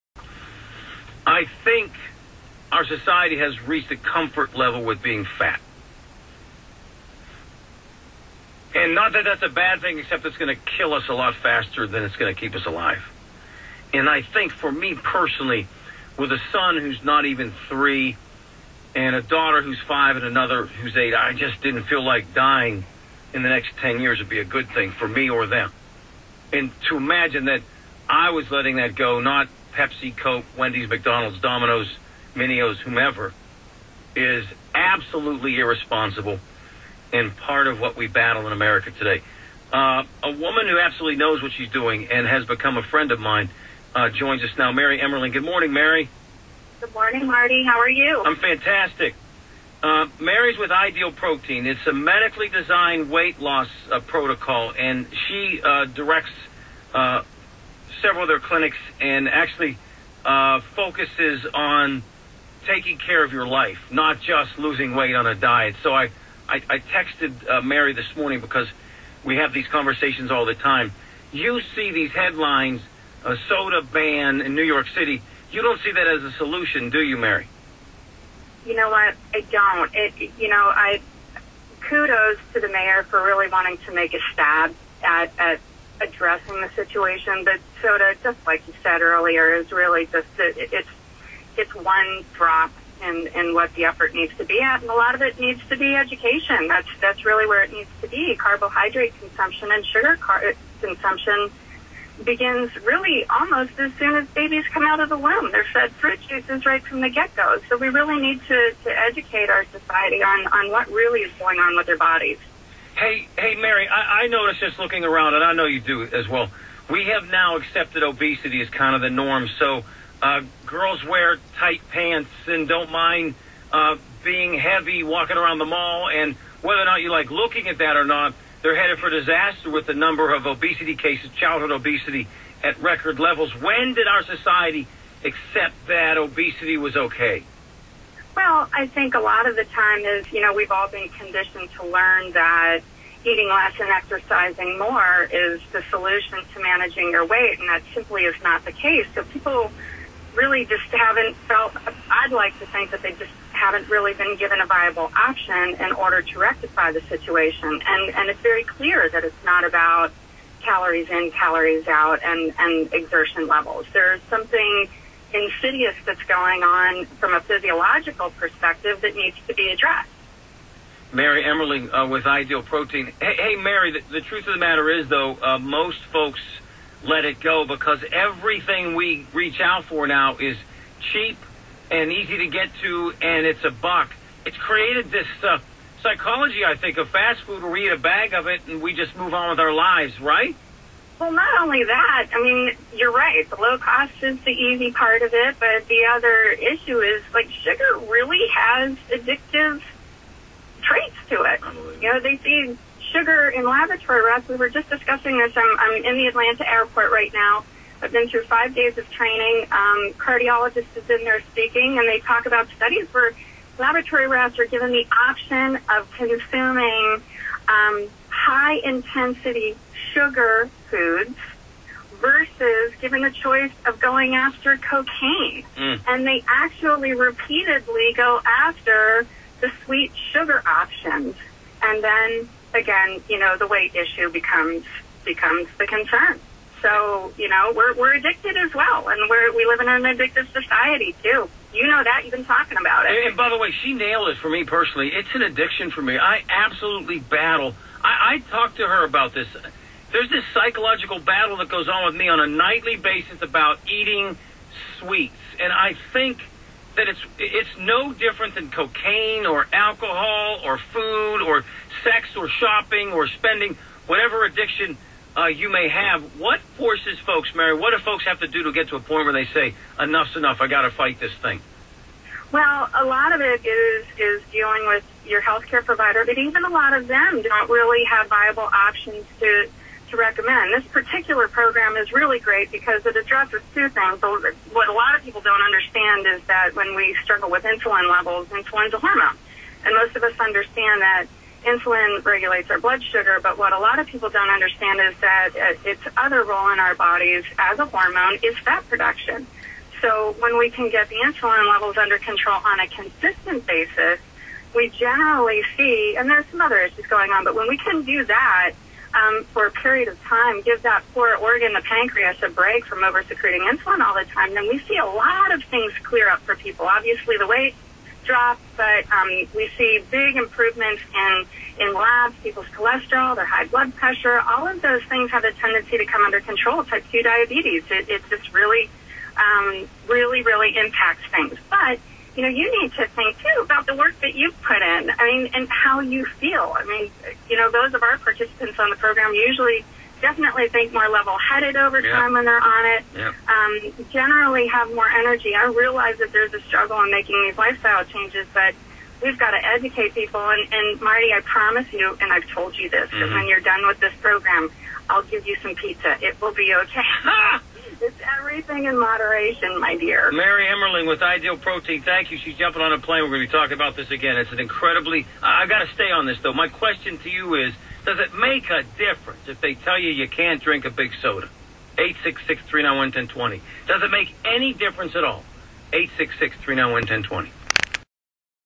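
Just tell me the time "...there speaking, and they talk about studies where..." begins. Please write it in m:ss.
3:31.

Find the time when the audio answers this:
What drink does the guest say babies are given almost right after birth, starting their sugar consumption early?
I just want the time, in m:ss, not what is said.
1:45.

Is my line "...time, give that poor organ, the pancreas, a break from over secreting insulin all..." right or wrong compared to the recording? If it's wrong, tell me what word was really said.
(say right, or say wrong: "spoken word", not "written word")
right.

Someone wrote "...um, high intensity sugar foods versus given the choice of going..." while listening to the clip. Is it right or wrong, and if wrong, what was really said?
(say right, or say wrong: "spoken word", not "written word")
right.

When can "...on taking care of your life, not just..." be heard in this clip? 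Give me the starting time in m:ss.
1:01.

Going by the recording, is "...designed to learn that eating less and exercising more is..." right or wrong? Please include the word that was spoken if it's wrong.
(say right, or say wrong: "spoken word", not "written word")
wrong: "conditioned", not "designed".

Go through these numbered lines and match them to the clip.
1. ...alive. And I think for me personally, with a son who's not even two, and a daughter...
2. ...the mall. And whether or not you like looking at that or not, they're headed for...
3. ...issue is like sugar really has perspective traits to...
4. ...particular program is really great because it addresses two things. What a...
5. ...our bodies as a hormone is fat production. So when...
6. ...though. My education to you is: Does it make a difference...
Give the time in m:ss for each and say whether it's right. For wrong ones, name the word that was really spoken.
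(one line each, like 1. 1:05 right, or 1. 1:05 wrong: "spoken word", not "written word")
1. 0:12 wrong: "three", not "two"
2. 2:05 right
3. 3:16 wrong: "addictive", not "perspective"
4. 4:40 right
5. 4:56 right
6. 6:06 wrong: "question", not "education".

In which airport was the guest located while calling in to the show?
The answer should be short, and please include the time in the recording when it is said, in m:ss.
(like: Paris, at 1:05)
Atlanta airport, at 3:26.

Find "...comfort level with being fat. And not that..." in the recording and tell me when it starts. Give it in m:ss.
0:03.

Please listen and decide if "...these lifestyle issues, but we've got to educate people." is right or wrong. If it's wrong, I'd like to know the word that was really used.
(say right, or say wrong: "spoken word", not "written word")
wrong: "changes", not "issues".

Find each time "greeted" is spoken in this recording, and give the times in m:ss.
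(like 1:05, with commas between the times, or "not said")
not said.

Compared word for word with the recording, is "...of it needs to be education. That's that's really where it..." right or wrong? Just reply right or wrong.
right.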